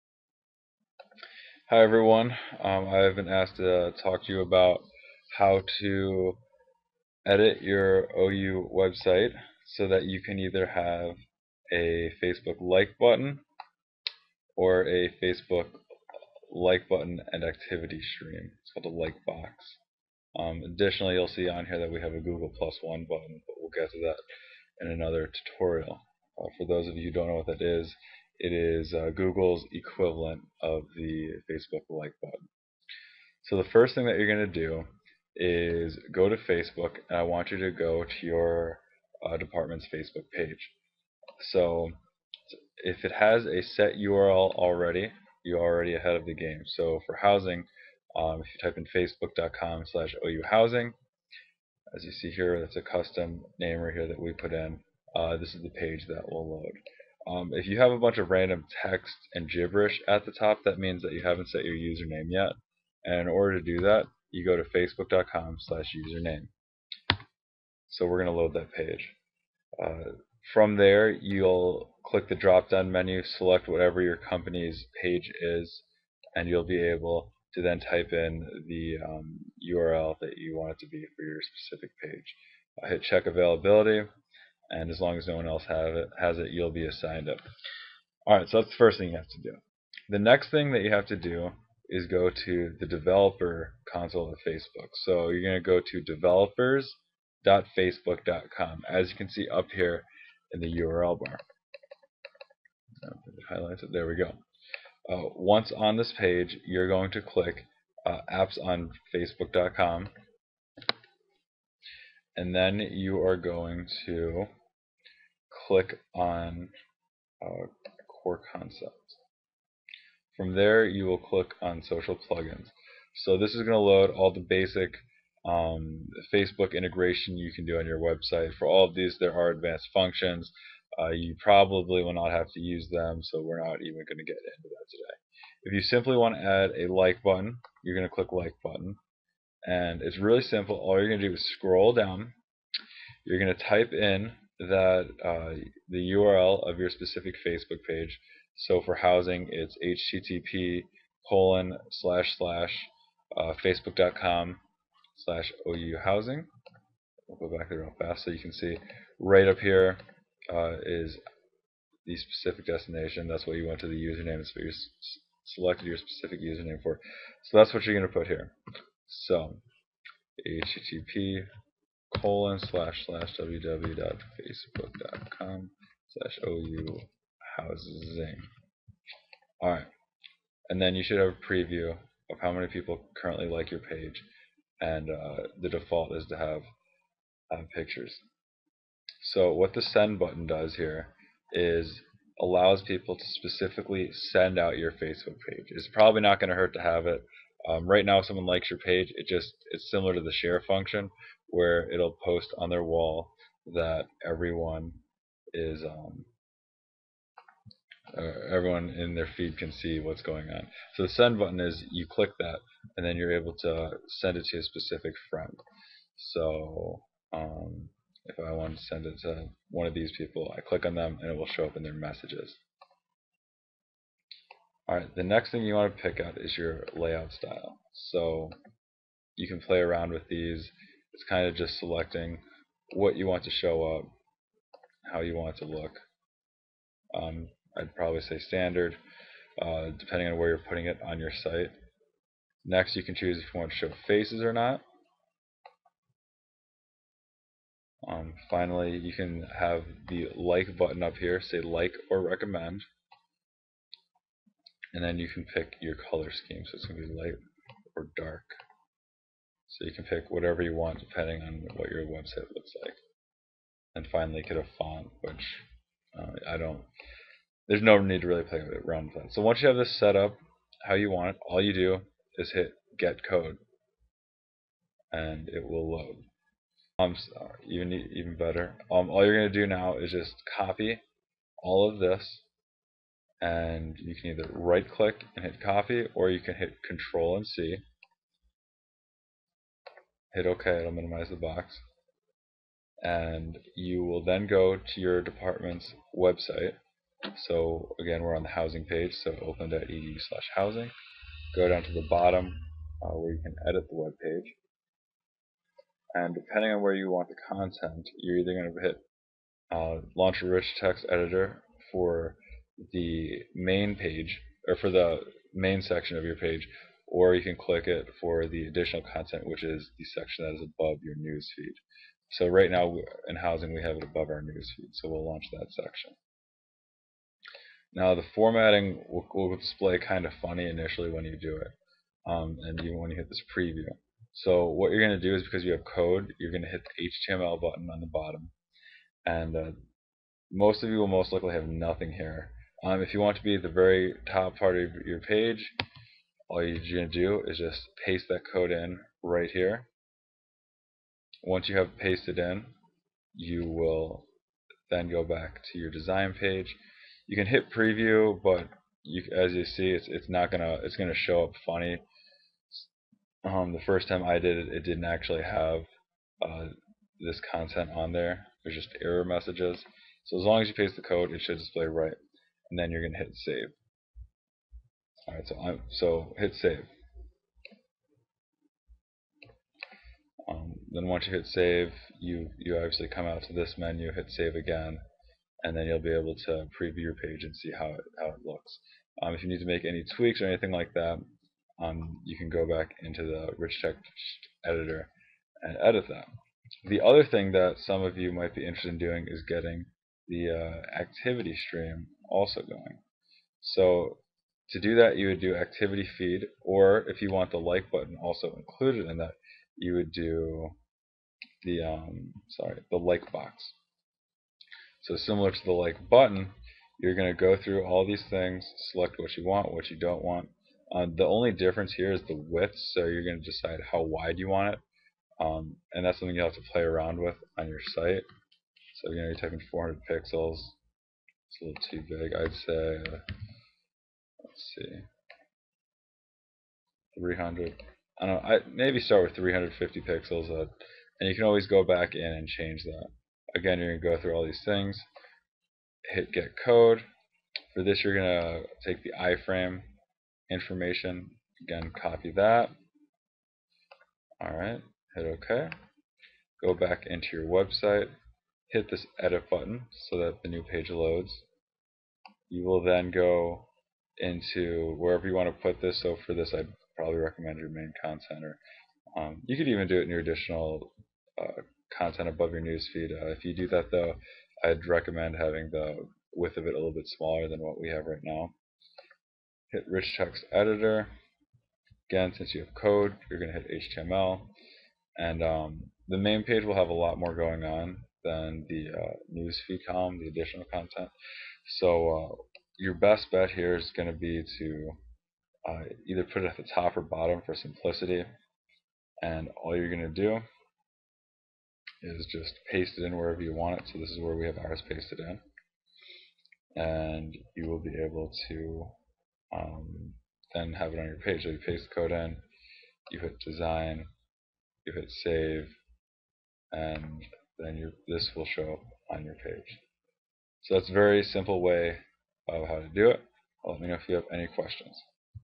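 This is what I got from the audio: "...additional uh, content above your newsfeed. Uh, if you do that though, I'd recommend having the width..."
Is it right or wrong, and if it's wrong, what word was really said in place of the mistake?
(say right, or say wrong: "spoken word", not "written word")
right.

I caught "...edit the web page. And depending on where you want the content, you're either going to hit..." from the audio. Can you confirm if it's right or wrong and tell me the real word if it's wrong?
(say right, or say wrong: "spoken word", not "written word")
right.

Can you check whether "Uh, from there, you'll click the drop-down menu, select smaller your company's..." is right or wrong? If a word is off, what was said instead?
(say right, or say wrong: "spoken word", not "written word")
wrong: "whatever", not "smaller".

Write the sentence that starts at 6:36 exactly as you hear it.
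The other thing that some of you might be interested in doing is getting the uh, activity stream also going.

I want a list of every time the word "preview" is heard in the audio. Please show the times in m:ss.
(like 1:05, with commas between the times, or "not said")
3:01, 5:33, 5:57, 6:26.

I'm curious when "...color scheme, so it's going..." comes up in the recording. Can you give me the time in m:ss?
4:16.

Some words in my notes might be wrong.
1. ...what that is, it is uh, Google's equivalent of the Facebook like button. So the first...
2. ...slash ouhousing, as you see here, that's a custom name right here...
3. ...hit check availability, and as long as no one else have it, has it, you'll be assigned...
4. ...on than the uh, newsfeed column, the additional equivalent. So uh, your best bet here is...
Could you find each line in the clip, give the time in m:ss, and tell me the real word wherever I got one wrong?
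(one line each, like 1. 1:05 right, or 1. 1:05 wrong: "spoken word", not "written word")
1. 0:27 right
2. 0:49 right
3. 1:22 right
4. 8:07 wrong: "content", not "equivalent".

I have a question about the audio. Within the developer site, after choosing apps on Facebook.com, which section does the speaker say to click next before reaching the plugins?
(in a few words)
Core Concepts.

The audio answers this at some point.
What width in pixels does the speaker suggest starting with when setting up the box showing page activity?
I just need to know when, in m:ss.
7:19.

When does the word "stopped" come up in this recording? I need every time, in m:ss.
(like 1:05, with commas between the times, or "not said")
not said.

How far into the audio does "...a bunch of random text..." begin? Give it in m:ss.
0:57.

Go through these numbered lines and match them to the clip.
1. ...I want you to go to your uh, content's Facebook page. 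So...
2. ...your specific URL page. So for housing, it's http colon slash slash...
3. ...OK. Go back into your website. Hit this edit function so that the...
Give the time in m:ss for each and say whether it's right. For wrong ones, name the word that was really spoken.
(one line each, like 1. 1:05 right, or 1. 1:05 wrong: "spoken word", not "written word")
1. 0:37 wrong: "department", not "content"
2. 2:26 wrong: "Facebook", not "URL"
3. 7:35 wrong: "button", not "function".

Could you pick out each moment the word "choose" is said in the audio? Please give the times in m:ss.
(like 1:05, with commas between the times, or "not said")
4:03.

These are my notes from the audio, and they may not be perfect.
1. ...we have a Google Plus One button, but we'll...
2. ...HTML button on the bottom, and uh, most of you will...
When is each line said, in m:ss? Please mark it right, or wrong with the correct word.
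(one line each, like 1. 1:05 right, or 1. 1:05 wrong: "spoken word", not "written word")
1. 0:21 right
2. 5:37 right.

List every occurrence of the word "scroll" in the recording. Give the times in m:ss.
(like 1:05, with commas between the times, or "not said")
2:21.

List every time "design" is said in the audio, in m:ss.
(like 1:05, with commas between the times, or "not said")
5:55, 8:33.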